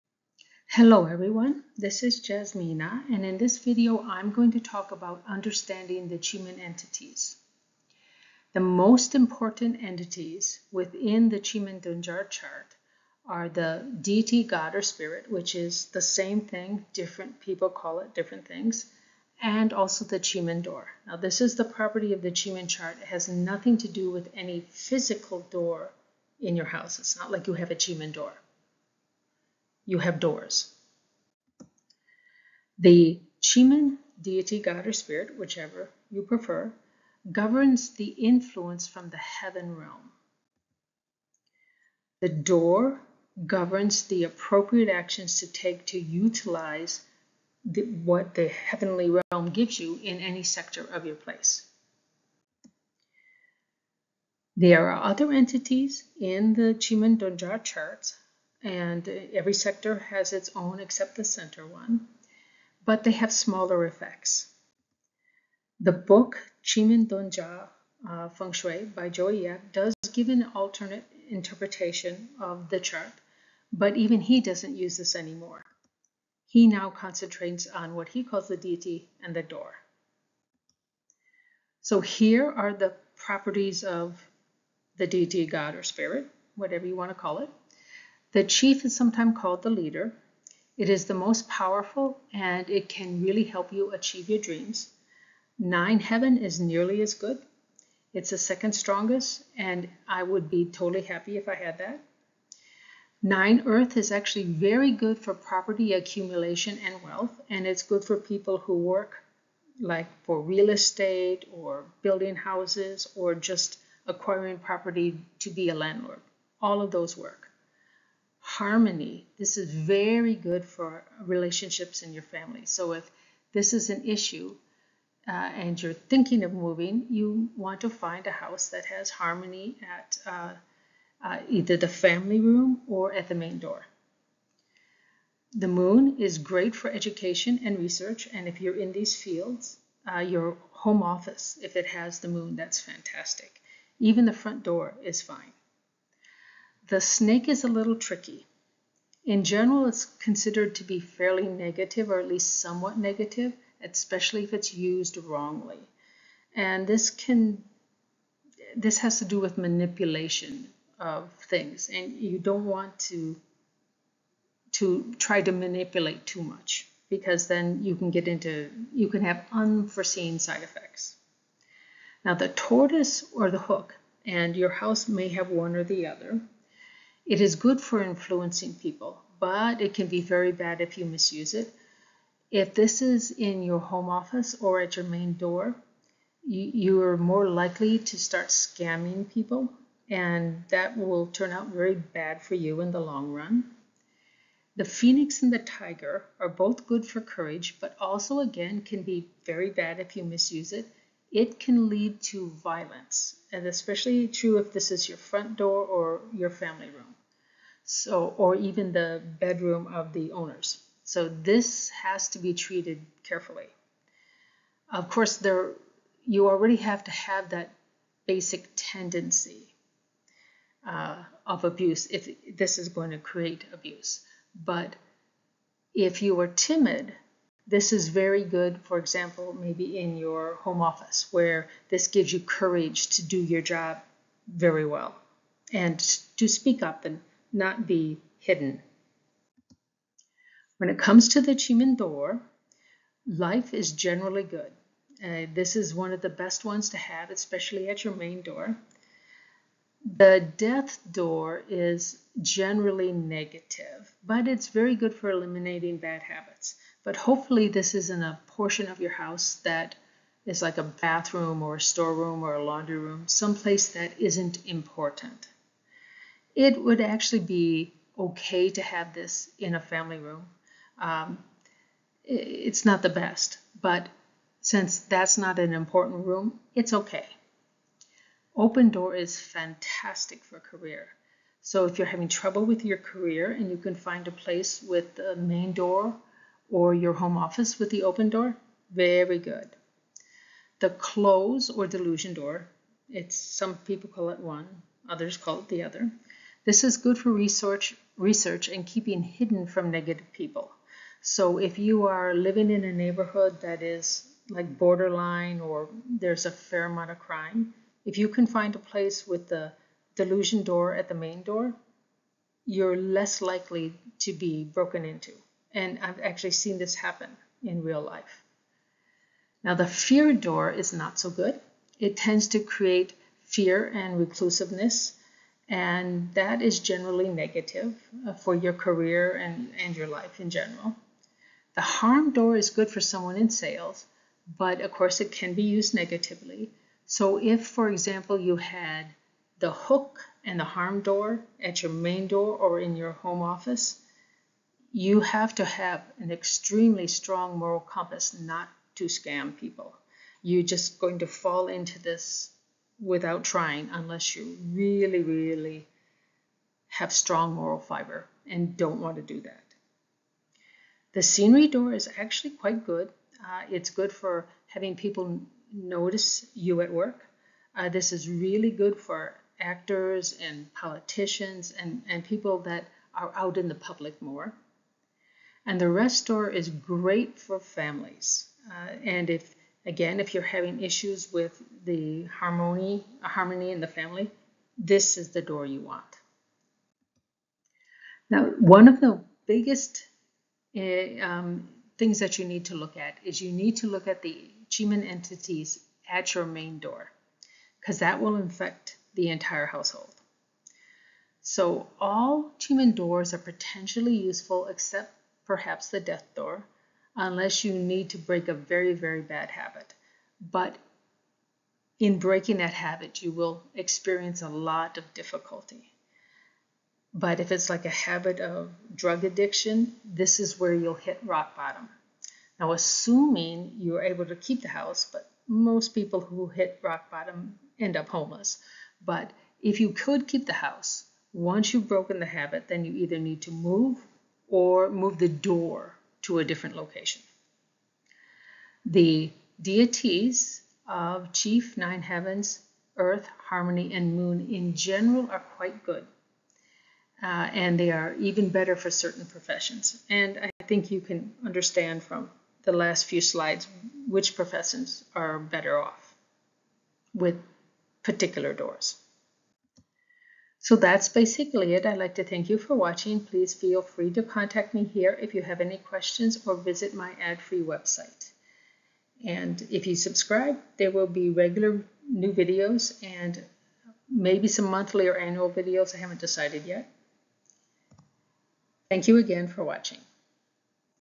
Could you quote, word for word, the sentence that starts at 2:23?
Even the front door is fine.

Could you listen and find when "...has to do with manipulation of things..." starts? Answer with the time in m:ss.
2:38.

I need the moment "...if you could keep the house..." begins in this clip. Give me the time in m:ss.
7:09.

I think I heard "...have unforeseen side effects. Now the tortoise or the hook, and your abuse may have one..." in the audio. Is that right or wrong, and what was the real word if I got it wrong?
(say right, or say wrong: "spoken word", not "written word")
wrong: "house", not "abuse".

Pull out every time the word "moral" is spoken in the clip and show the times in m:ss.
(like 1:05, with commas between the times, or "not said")
5:47, 5:57.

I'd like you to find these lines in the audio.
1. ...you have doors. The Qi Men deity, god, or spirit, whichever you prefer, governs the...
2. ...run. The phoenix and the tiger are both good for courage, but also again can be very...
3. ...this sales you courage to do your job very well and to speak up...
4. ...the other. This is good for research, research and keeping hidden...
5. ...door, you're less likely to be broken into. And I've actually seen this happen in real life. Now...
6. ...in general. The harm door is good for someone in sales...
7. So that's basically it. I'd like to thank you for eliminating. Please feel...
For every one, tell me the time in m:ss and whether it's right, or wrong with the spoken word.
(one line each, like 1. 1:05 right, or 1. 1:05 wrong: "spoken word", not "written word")
1. 0:29 right
2. 3:13 right
3. 3:51 wrong: "gives", not "sales"
4. 4:55 right
5. 5:11 right
6. 5:30 right
7. 7:40 wrong: "watching", not "eliminating".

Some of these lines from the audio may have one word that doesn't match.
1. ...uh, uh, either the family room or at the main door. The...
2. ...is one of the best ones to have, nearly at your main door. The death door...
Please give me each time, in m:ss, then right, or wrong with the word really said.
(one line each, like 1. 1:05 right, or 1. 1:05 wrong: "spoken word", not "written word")
1. 2:10 right
2. 4:05 wrong: "especially", not "nearly".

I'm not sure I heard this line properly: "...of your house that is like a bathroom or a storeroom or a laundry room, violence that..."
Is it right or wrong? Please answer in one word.
wrong.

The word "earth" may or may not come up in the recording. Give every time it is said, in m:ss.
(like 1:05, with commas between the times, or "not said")
1:43, 7:22.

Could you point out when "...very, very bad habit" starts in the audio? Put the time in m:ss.
6:48.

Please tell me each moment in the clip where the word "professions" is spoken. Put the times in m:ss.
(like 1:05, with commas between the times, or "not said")
7:29, 7:34.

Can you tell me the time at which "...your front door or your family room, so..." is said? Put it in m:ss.
3:25.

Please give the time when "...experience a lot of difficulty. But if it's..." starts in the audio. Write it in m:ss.
6:53.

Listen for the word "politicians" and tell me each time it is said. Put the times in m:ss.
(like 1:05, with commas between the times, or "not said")
6:10.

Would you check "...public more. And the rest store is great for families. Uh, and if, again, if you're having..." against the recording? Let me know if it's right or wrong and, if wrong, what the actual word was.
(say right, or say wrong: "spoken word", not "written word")
right.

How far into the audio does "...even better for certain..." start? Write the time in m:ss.
7:28.